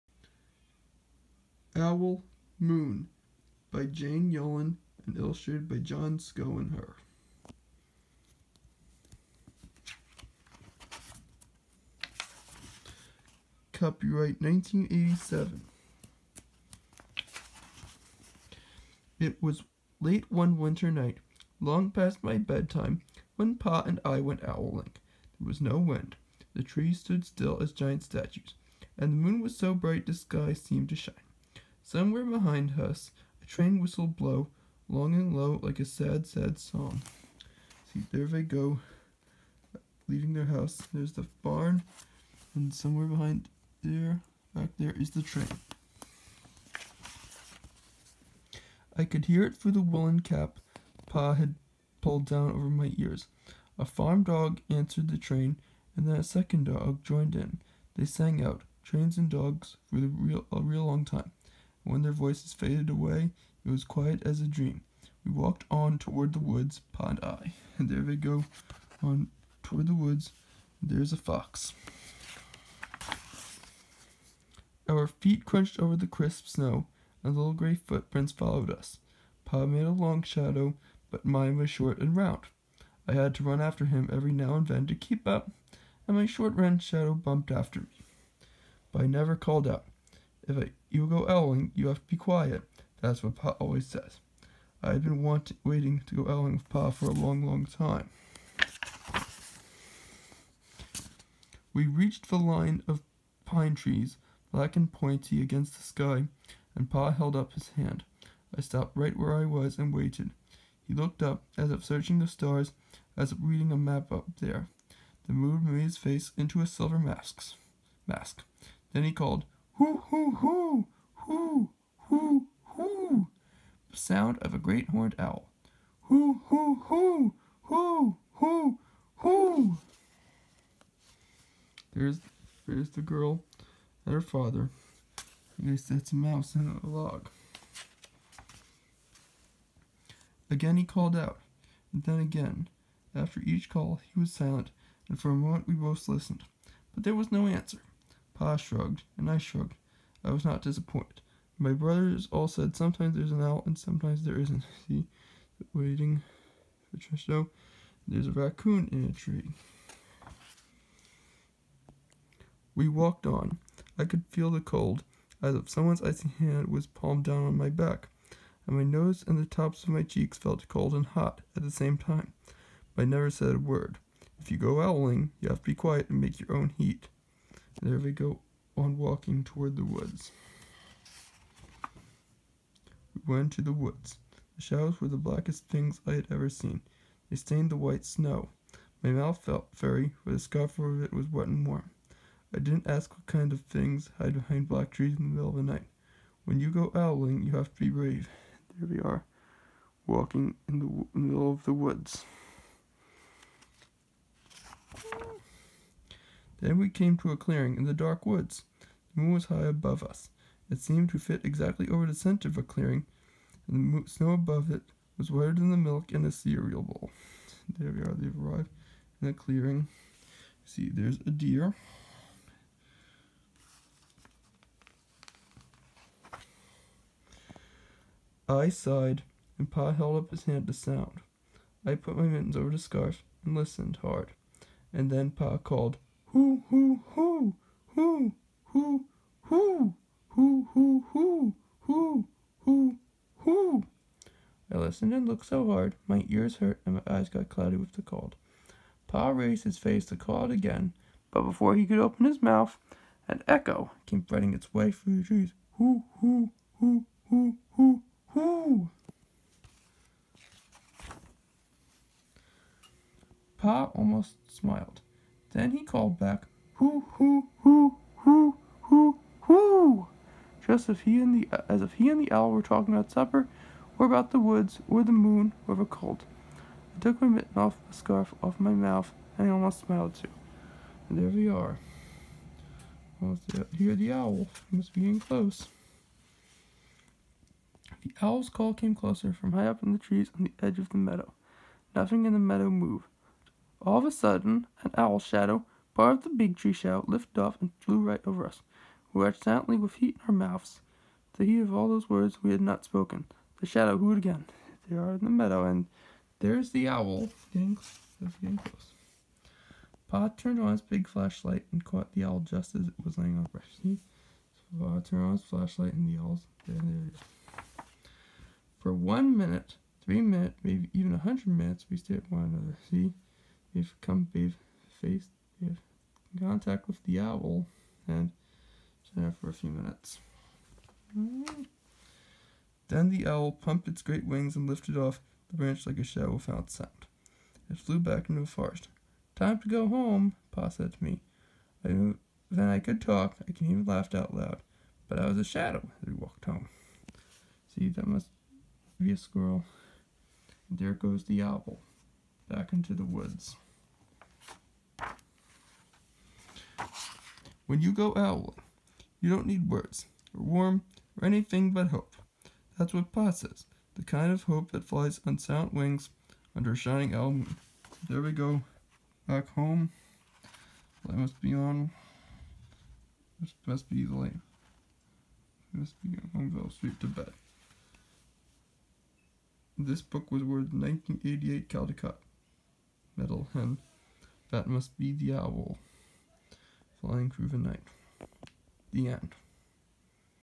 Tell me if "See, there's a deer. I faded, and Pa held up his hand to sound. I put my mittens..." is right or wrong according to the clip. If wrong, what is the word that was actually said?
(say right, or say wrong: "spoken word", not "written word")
wrong: "sighed", not "faded".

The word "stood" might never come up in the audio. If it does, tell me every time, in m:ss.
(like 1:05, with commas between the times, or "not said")
0:26.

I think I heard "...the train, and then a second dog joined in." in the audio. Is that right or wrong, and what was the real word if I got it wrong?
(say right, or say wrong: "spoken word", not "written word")
right.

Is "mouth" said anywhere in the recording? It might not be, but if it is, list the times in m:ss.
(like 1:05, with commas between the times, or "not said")
3:09, 4:12, 4:38, 5:00.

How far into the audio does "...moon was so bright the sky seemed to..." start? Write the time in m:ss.
0:29.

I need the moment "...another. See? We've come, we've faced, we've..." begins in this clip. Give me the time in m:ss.
5:22.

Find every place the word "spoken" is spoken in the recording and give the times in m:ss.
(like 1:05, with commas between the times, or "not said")
5:02.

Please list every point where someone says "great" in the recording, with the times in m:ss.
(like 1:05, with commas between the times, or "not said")
2:04, 5:34.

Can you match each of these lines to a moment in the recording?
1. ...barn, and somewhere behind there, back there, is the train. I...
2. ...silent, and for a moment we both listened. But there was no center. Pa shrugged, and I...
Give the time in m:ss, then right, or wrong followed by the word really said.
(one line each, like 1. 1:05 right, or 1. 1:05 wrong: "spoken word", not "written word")
1. 0:41 right
2. 2:24 wrong: "answer", not "center".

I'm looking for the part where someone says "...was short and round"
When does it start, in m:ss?
1:21.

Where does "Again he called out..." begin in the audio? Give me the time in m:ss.
2:20.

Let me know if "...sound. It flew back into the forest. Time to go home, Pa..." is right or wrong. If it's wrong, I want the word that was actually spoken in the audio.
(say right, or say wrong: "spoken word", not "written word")
right.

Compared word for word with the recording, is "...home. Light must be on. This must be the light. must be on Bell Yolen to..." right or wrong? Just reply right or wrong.
wrong.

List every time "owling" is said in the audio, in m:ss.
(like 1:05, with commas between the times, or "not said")
0:24, 1:31, 1:36, 2:54, 3:16, 5:58.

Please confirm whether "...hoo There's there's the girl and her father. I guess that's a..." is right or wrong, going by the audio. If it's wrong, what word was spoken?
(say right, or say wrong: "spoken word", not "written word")
right.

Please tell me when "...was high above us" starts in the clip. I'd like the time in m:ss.
3:29.